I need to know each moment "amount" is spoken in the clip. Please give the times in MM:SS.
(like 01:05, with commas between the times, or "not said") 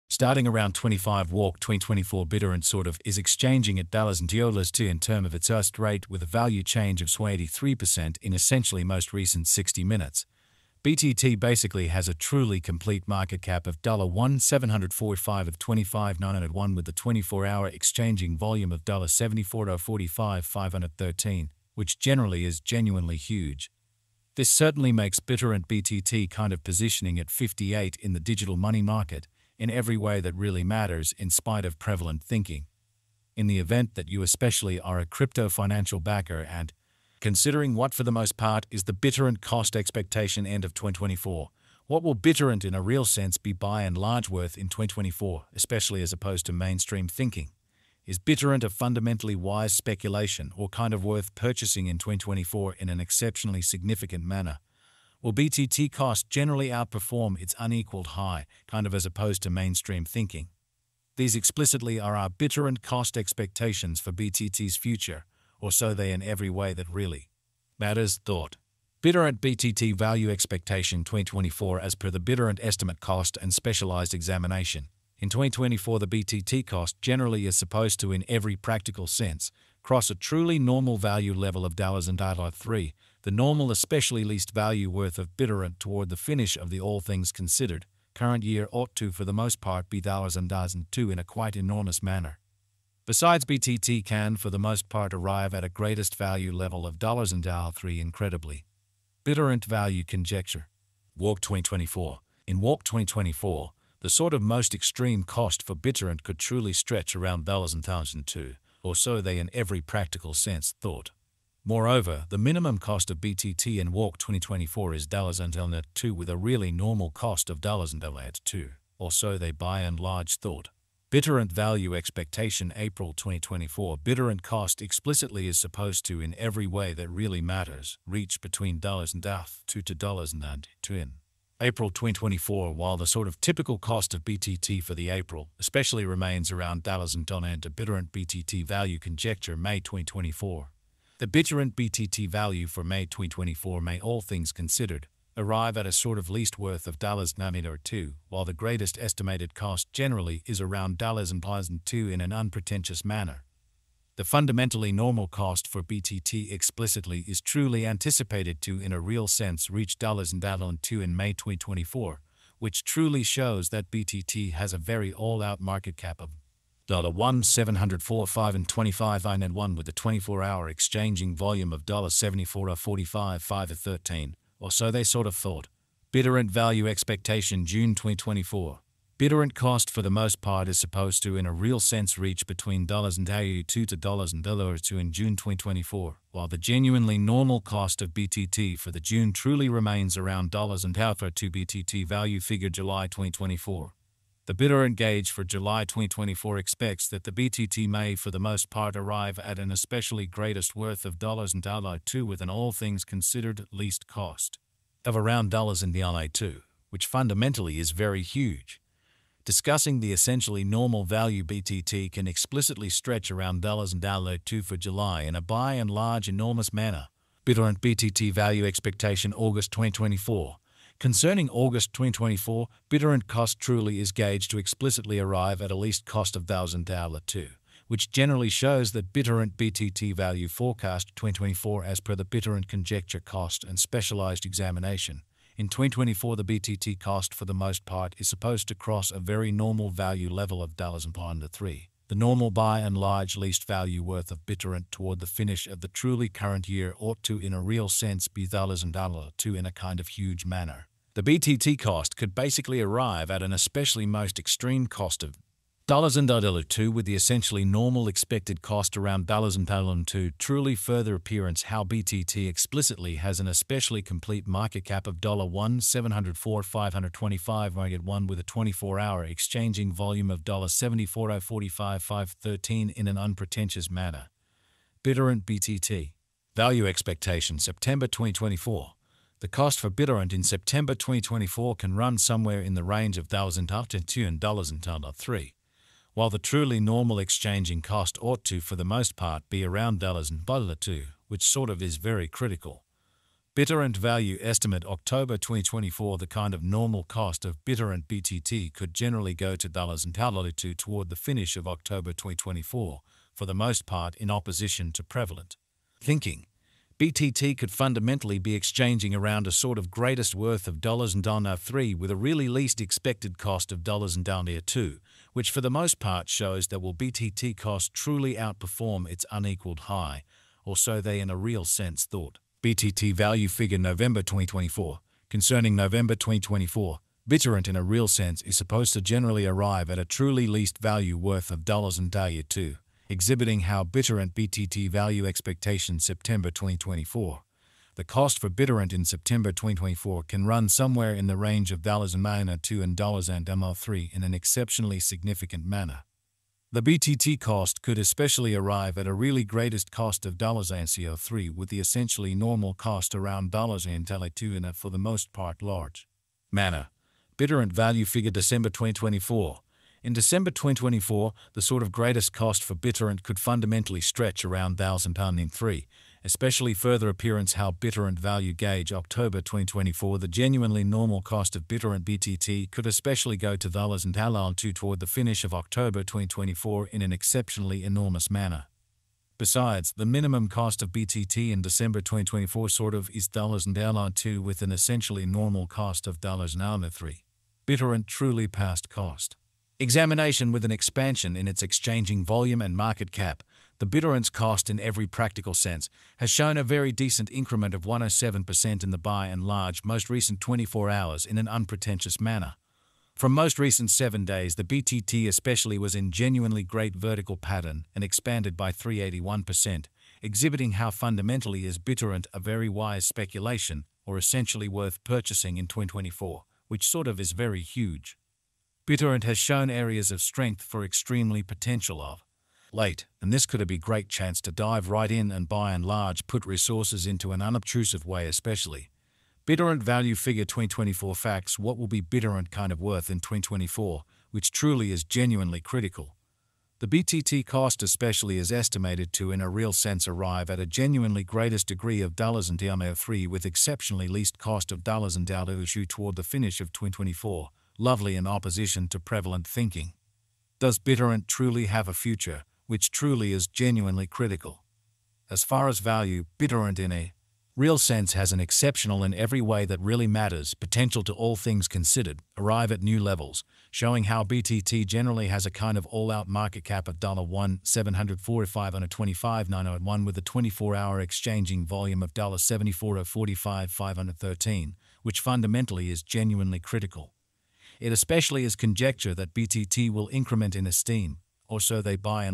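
not said.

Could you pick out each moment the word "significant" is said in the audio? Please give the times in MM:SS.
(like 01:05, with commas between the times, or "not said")
00:53, 05:45.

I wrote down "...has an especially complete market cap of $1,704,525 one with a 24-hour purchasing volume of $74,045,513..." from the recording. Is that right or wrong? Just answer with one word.
wrong.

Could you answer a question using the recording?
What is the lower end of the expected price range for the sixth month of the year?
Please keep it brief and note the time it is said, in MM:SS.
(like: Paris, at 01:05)
$1.82, at 03:02.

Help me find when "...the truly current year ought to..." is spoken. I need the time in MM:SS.
04:05.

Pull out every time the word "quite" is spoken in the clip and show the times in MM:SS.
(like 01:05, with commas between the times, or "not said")
01:31.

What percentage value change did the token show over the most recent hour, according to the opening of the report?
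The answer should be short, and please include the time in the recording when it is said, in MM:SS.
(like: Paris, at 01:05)
83%, at 00:07.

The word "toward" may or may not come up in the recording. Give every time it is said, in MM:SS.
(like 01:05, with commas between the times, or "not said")
01:25, 04:04, 05:00, 06:14, 07:25.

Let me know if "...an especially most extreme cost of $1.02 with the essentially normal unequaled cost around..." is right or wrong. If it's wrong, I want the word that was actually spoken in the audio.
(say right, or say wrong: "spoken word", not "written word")
wrong: "expected", not "unequaled".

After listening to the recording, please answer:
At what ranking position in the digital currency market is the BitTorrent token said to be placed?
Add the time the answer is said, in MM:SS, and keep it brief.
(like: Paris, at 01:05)
58, at 00:27.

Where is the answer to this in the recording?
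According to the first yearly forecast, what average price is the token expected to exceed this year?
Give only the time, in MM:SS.
01:21.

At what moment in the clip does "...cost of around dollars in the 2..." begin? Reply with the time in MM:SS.
03:24.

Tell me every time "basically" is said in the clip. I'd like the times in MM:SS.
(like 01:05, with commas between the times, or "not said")
00:11, 04:12.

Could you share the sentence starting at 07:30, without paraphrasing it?
Does BitTorrent truly have a future, which truly is genuinely critical?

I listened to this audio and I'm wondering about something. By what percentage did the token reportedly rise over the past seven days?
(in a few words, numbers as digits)
381%.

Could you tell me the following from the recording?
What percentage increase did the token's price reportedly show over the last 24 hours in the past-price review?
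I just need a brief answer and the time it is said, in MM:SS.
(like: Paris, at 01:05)
107%, at 06:37.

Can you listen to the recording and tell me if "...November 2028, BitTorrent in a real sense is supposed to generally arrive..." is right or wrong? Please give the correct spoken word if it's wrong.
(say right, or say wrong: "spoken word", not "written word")
wrong: "2024", not "2028".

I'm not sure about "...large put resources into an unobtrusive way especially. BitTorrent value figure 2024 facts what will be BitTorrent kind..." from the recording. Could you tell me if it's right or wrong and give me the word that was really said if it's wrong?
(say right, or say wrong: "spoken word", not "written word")
right.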